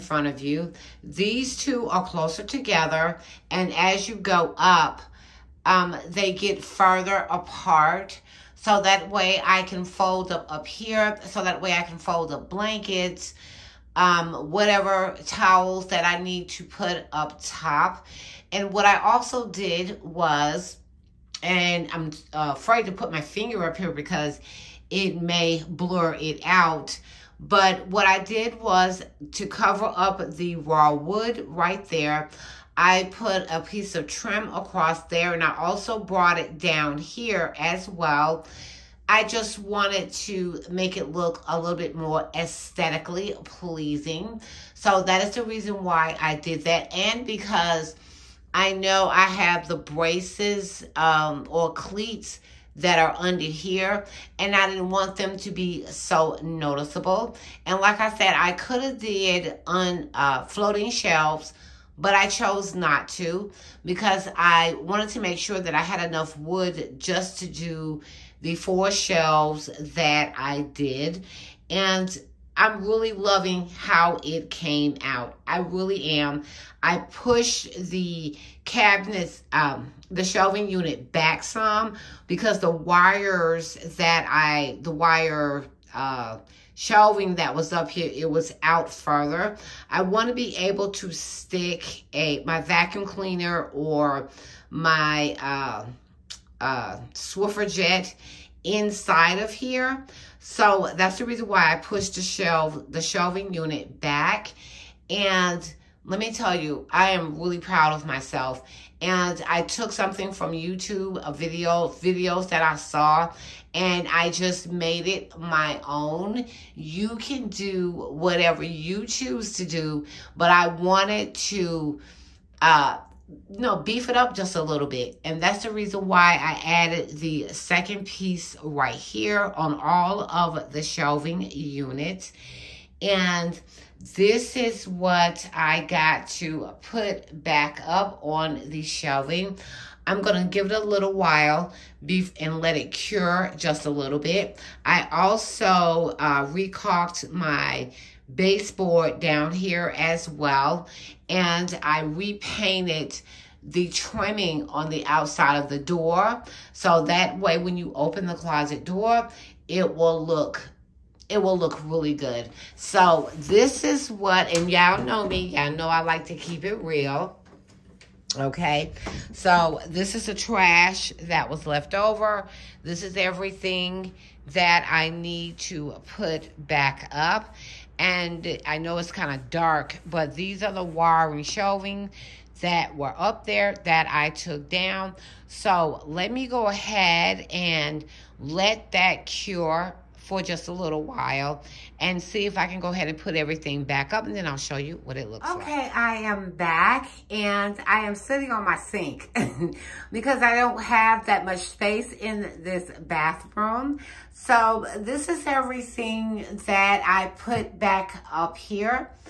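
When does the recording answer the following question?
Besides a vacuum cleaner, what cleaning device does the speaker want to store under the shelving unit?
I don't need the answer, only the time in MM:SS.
01:37.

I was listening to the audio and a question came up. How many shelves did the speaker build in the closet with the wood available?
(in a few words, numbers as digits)
4.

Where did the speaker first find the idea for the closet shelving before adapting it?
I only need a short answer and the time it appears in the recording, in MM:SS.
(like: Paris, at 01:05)
YouTube, at 01:50.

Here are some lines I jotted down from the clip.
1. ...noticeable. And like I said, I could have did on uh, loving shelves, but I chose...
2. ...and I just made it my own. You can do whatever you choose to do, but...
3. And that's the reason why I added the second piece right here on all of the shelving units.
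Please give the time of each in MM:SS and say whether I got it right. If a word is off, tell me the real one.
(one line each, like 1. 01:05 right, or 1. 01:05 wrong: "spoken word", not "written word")
1. 00:56 wrong: "floating", not "loving"
2. 01:53 right
3. 02:05 right.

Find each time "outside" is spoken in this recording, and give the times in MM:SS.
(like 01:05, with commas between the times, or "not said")
02:35.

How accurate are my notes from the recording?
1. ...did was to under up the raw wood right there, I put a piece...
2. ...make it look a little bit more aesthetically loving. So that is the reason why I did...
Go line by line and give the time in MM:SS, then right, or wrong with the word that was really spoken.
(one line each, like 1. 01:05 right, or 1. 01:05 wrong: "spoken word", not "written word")
1. 00:28 wrong: "cover", not "under"
2. 00:40 wrong: "pleasing", not "loving".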